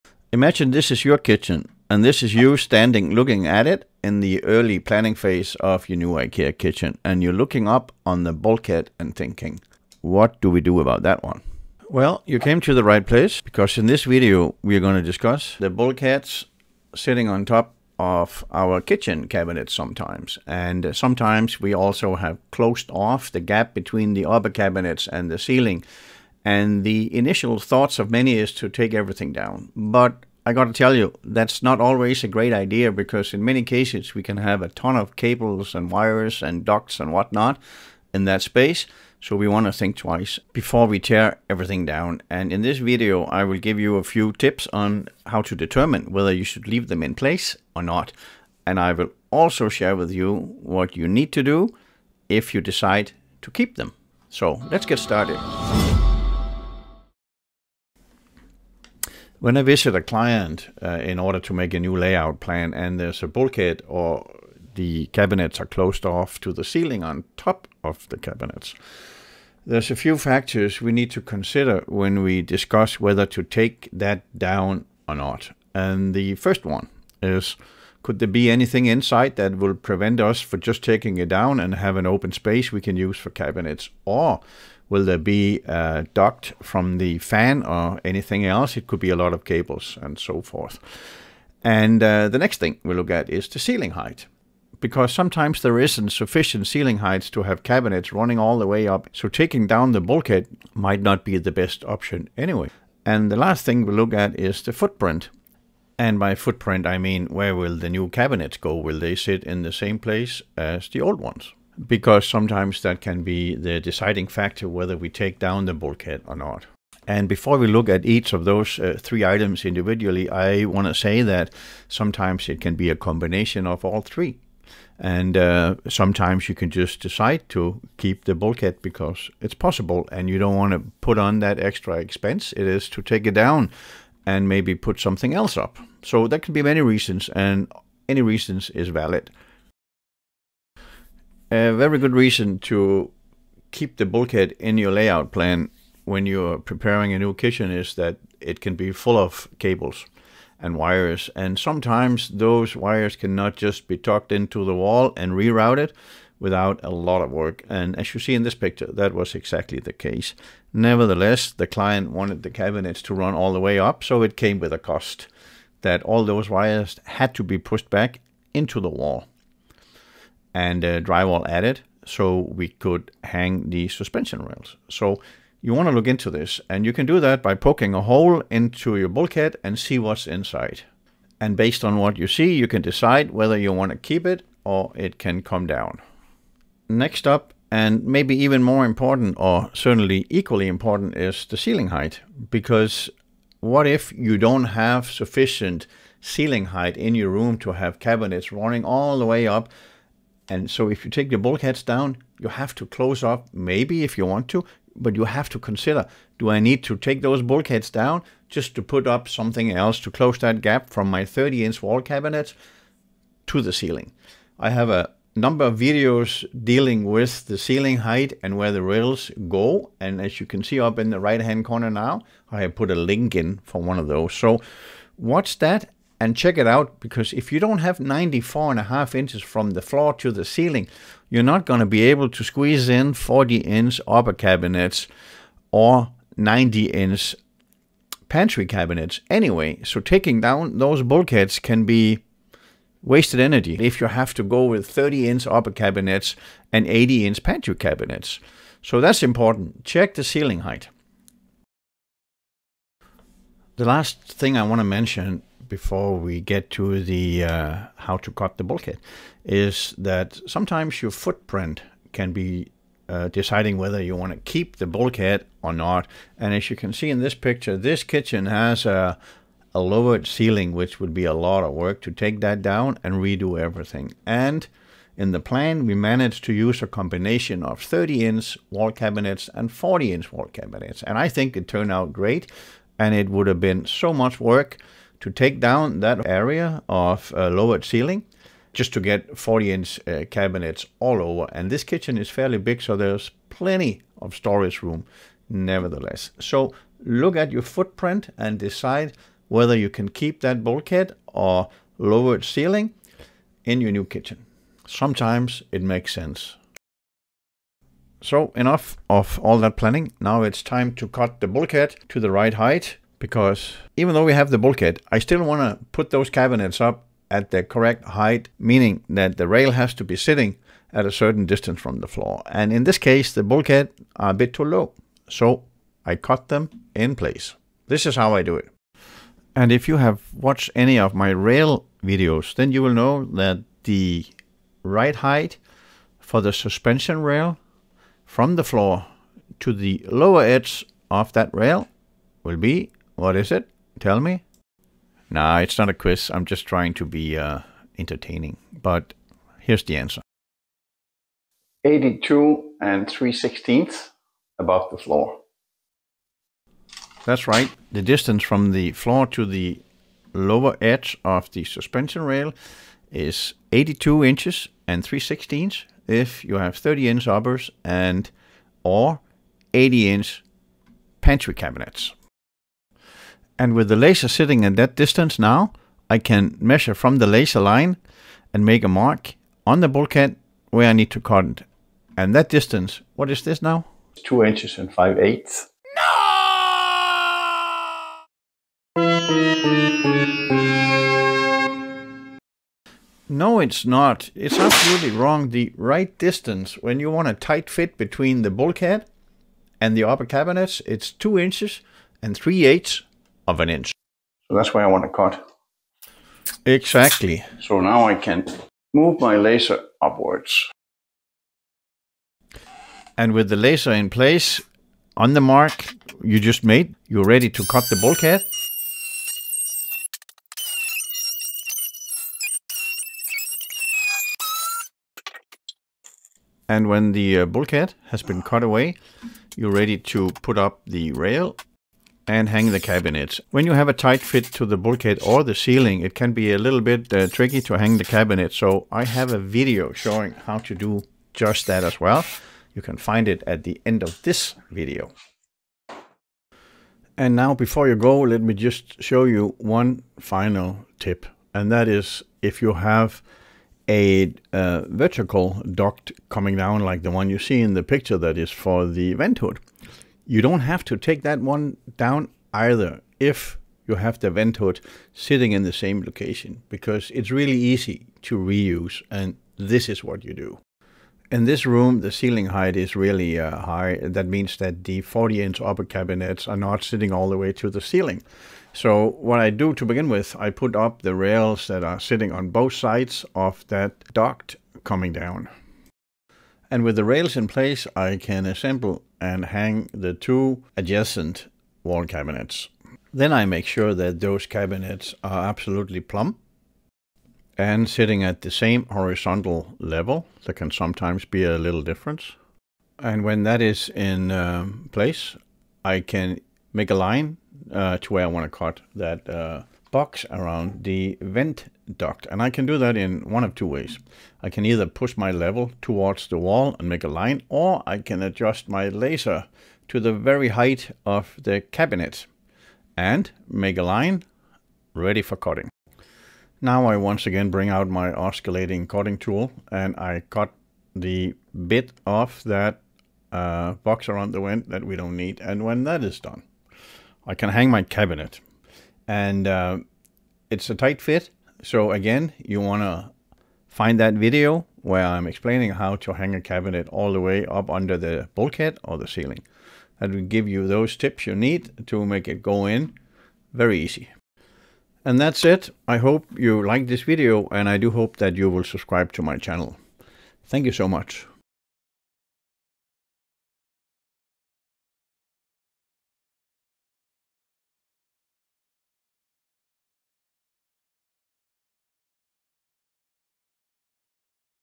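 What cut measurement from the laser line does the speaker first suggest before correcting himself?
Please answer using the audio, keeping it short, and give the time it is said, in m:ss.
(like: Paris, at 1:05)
2 5/8 inches, at 6:24.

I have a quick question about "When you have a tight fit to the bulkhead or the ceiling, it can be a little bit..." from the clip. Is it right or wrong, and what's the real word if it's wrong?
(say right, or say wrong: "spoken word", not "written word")
right.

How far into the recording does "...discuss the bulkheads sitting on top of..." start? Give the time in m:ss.
0:15.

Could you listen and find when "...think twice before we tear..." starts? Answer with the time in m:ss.
0:39.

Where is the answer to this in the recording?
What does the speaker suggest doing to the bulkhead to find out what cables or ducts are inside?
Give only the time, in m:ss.
2:57.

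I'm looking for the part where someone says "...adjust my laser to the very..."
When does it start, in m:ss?
8:38.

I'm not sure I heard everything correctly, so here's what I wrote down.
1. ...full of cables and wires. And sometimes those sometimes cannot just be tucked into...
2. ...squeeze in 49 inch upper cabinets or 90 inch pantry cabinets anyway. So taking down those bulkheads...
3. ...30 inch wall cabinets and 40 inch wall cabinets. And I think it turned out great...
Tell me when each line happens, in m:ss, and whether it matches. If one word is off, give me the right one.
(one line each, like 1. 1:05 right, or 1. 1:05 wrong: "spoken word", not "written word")
1. 2:28 wrong: "wires", not "sometimes"
2. 3:52 wrong: "40", not "49"
3. 4:37 right.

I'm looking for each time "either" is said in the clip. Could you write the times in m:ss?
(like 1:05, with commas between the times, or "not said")
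7:42, 8:34.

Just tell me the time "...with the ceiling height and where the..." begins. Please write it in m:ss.
3:37.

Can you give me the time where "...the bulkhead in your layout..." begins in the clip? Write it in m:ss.
2:23.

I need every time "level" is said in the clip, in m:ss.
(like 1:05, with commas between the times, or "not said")
8:19, 8:35.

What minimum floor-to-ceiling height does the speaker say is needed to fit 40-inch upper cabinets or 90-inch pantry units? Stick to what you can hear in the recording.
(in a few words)
94 1/2 inches.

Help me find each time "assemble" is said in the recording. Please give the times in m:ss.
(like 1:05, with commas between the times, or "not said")
8:08.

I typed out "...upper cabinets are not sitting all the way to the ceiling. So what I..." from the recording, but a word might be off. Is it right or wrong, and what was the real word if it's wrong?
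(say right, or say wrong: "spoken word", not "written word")
right.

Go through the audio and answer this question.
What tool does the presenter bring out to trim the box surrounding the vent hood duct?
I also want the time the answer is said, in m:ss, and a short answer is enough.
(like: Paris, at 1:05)
oscillating cutting tool, at 8:48.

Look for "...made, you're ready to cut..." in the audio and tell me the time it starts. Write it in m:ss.
6:56.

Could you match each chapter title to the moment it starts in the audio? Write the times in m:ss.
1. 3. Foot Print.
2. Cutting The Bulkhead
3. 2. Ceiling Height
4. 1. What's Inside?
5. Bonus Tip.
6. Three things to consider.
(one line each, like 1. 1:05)
1. 4:12
2. 5:08
3. 3:07
4. 2:20
5. 7:27
6. 0:57.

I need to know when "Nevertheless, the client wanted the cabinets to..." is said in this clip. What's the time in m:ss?
2:40.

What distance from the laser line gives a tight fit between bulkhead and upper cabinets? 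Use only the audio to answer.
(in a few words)
2 3/8 inches.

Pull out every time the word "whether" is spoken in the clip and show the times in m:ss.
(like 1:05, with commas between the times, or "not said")
0:46, 1:12, 1:54, 3:03, 4:23, 4:59.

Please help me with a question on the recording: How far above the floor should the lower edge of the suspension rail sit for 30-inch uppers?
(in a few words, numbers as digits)
82 3/16 inches.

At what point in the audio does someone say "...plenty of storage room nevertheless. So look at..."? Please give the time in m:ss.
4:53.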